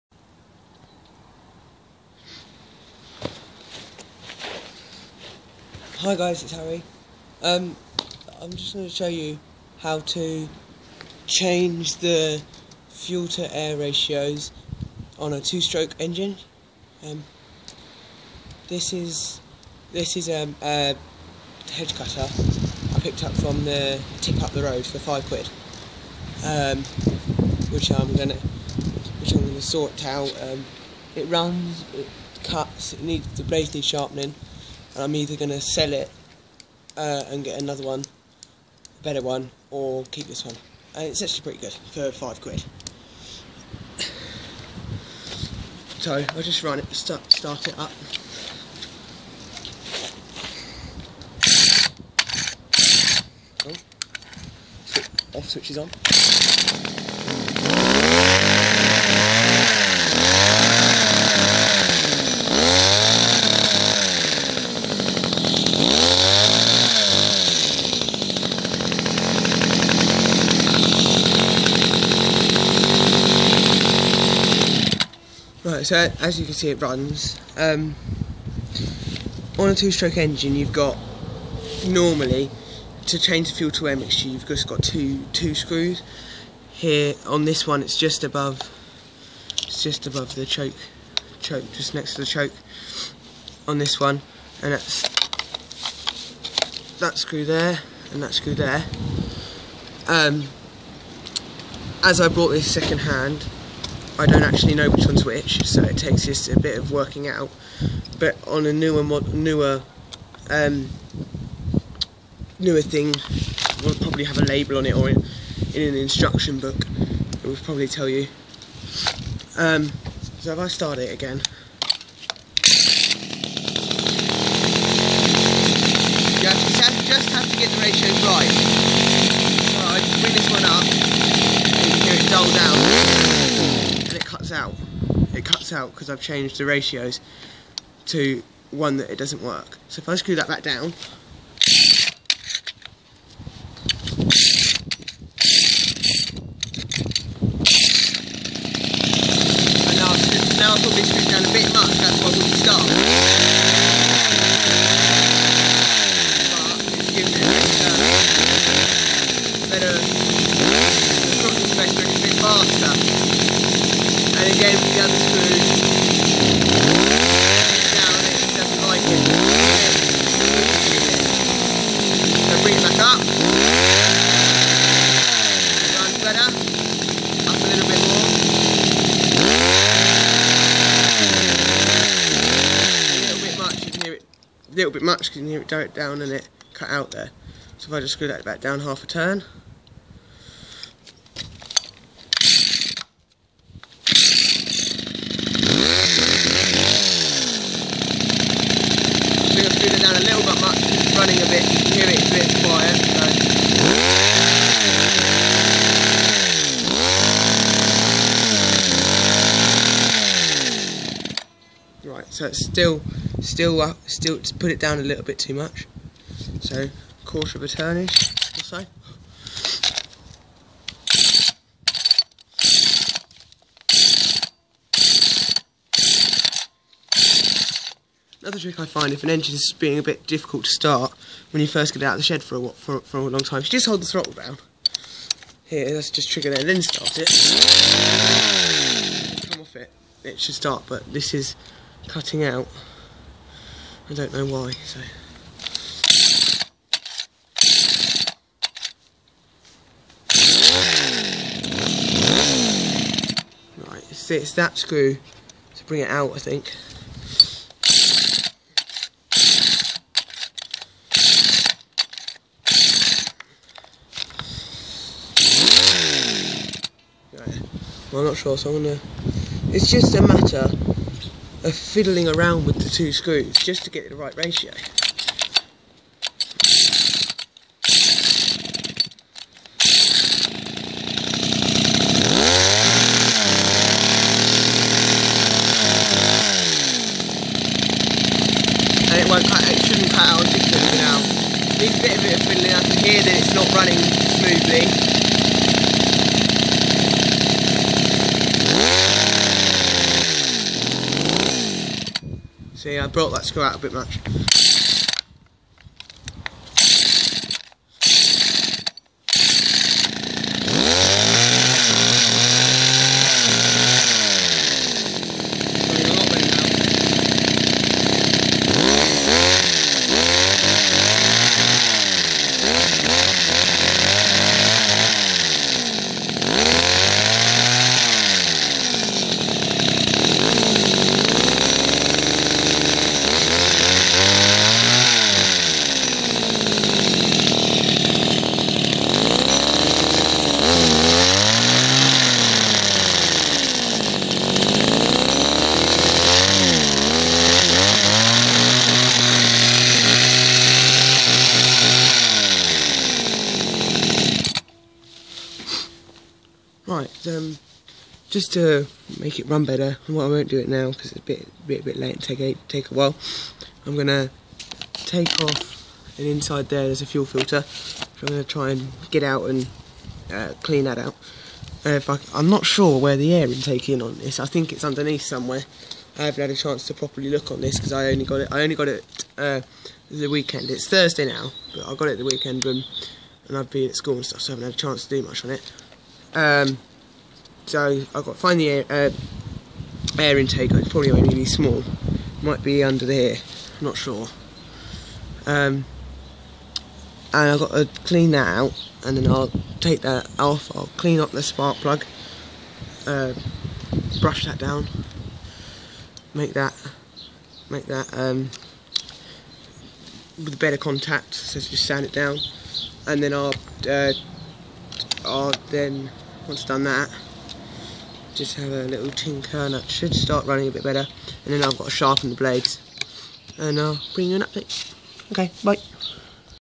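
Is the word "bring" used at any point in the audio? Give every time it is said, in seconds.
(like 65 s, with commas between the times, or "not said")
130 s, 172 s, 255 s, 424 s.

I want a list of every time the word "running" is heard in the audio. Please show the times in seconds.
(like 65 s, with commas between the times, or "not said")
293 s, 420 s.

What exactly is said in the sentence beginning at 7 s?
Um, I'm just going to show you how to change the fuel to air ratios on a two-stroke engine.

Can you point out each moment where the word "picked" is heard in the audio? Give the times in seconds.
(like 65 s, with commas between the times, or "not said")
23 s.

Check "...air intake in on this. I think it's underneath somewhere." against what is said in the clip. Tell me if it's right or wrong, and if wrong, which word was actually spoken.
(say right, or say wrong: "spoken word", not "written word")
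right.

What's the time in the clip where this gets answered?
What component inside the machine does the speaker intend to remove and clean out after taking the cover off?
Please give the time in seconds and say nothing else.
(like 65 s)
367 s.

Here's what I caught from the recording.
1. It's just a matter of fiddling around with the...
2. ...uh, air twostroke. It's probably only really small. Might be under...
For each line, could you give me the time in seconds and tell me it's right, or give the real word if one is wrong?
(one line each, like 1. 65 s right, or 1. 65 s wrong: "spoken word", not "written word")
1. 269 s right
2. 388 s wrong: "intake", not "twostroke".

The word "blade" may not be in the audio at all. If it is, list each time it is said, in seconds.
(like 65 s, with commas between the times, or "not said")
33 s, 422 s.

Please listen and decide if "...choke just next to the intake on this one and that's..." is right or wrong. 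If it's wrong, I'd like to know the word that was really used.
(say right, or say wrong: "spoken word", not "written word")
wrong: "choke", not "intake".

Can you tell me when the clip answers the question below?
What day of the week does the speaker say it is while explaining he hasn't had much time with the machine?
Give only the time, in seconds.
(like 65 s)
380 s.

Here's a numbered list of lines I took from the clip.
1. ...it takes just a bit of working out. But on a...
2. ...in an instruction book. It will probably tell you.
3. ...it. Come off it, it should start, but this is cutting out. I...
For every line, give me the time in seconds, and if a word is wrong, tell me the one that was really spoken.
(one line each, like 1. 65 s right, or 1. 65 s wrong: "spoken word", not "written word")
1. 105 s right
2. 115 s right
3. 237 s right.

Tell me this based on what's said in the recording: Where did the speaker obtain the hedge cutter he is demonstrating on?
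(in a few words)
the tip.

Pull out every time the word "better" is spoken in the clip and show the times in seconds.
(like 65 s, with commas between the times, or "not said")
39 s, 157 s, 172 s, 359 s, 410 s, 420 s.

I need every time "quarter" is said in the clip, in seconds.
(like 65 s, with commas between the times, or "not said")
217 s.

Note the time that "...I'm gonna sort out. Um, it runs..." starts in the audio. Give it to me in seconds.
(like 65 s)
29 s.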